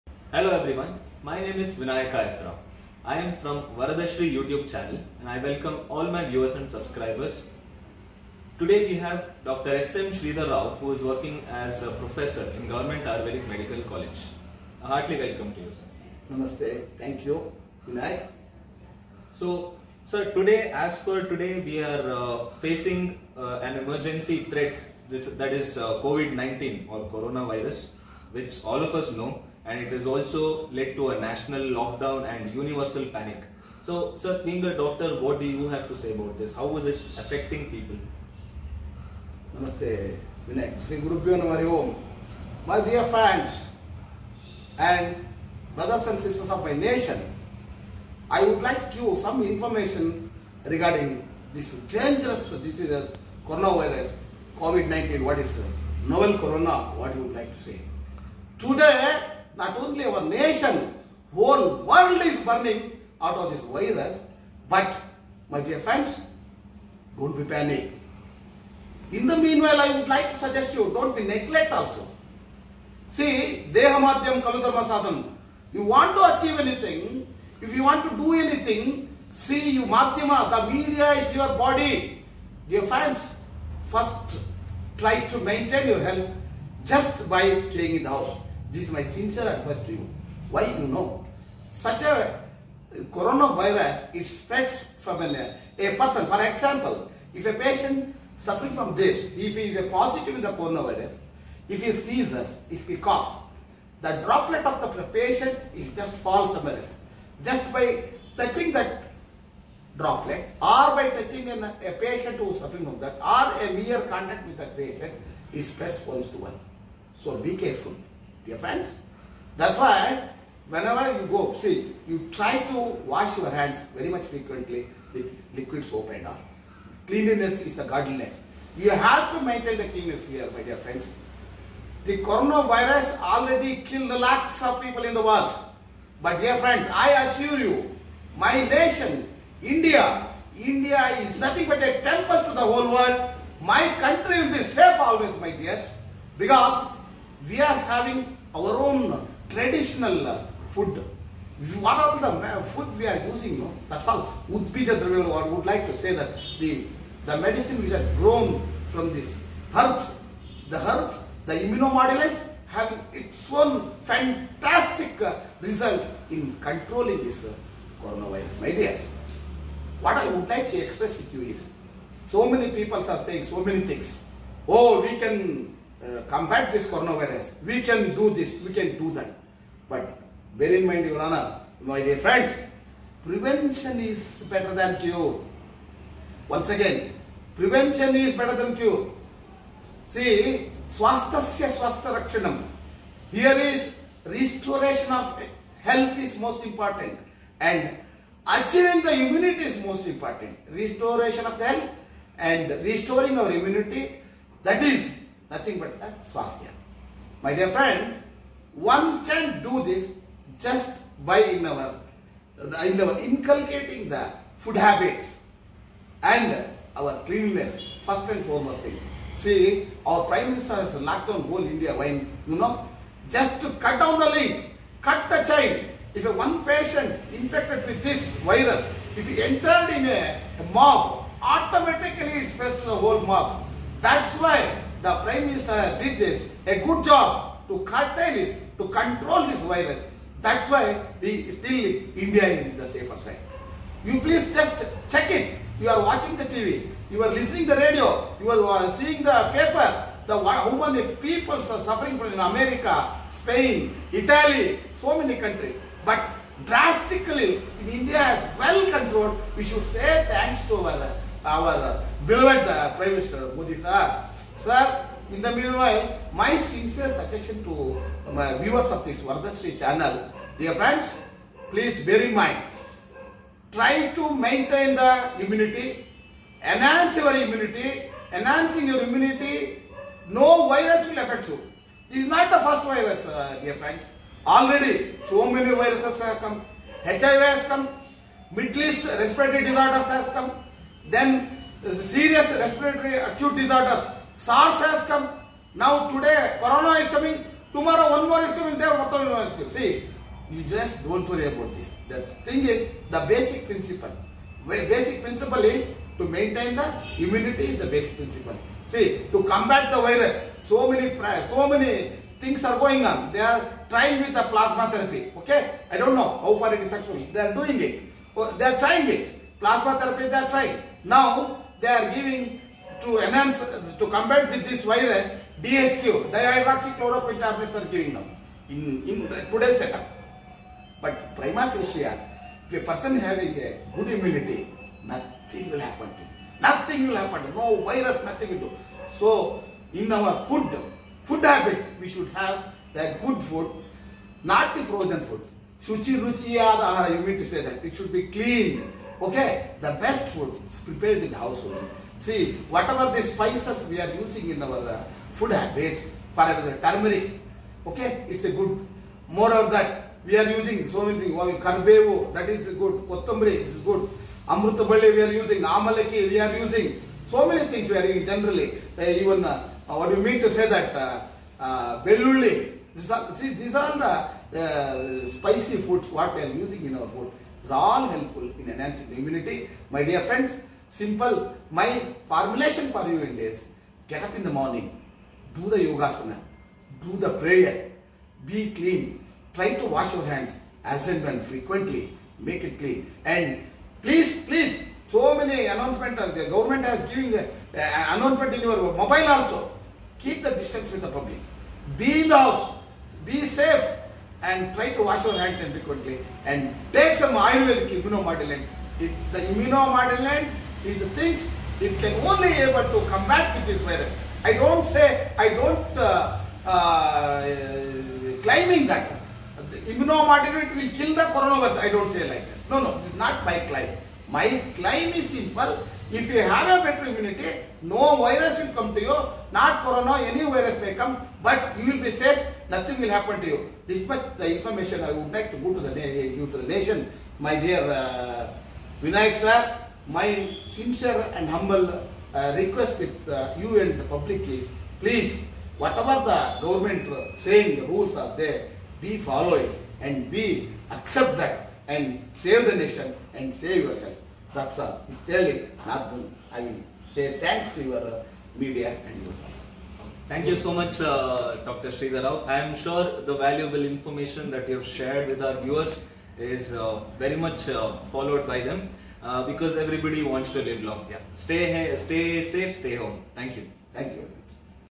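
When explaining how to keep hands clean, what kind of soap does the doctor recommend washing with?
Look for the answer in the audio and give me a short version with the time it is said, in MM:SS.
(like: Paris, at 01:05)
liquid soap, at 02:05.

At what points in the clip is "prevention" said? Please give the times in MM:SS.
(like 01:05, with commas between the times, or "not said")
03:03, 03:07.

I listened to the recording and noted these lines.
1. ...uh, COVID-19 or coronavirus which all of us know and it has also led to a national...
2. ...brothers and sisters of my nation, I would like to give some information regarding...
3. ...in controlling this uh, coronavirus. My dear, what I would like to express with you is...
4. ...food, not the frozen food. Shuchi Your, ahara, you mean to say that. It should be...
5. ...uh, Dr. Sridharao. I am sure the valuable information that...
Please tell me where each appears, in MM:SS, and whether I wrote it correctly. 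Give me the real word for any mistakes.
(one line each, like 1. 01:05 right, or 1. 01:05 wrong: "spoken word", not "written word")
1. 00:25 right
2. 00:45 right
3. 02:46 right
4. 05:43 wrong: "Ruchi", not "Your"
5. 07:41 right.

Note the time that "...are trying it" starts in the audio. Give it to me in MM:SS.
05:18.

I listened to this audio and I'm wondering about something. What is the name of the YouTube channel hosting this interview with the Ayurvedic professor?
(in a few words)
Varadashri.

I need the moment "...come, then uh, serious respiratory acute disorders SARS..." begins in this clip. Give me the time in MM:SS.
04:50.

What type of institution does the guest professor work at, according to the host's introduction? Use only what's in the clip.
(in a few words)
Government Ayurvedic Medical College.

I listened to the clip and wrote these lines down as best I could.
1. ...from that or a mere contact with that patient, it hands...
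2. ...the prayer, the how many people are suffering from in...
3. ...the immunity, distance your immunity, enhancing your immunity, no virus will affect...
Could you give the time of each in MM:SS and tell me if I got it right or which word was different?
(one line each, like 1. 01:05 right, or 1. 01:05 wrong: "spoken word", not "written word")
1. 01:52 wrong: "spreads", not "hands"
2. 04:09 wrong: "paper", not "prayer"
3. 04:34 wrong: "enhance", not "distance".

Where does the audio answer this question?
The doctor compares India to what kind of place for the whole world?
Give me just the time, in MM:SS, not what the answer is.
02:21.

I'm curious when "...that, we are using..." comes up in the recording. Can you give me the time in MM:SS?
05:59.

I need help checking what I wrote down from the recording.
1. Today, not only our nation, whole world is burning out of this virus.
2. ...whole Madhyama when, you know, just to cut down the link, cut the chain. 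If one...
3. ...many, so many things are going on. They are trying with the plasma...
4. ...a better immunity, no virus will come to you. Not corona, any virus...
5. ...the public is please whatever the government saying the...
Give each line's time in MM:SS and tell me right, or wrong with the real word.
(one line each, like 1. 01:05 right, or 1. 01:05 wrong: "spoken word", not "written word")
1. 00:58 right
2. 03:41 wrong: "India", not "Madhyama"
3. 05:10 right
4. 07:06 right
5. 07:23 right.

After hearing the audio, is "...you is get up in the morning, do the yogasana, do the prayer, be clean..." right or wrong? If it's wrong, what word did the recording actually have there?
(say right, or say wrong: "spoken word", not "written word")
right.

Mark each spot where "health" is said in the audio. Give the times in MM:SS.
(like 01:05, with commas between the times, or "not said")
01:25, 03:15, 03:21.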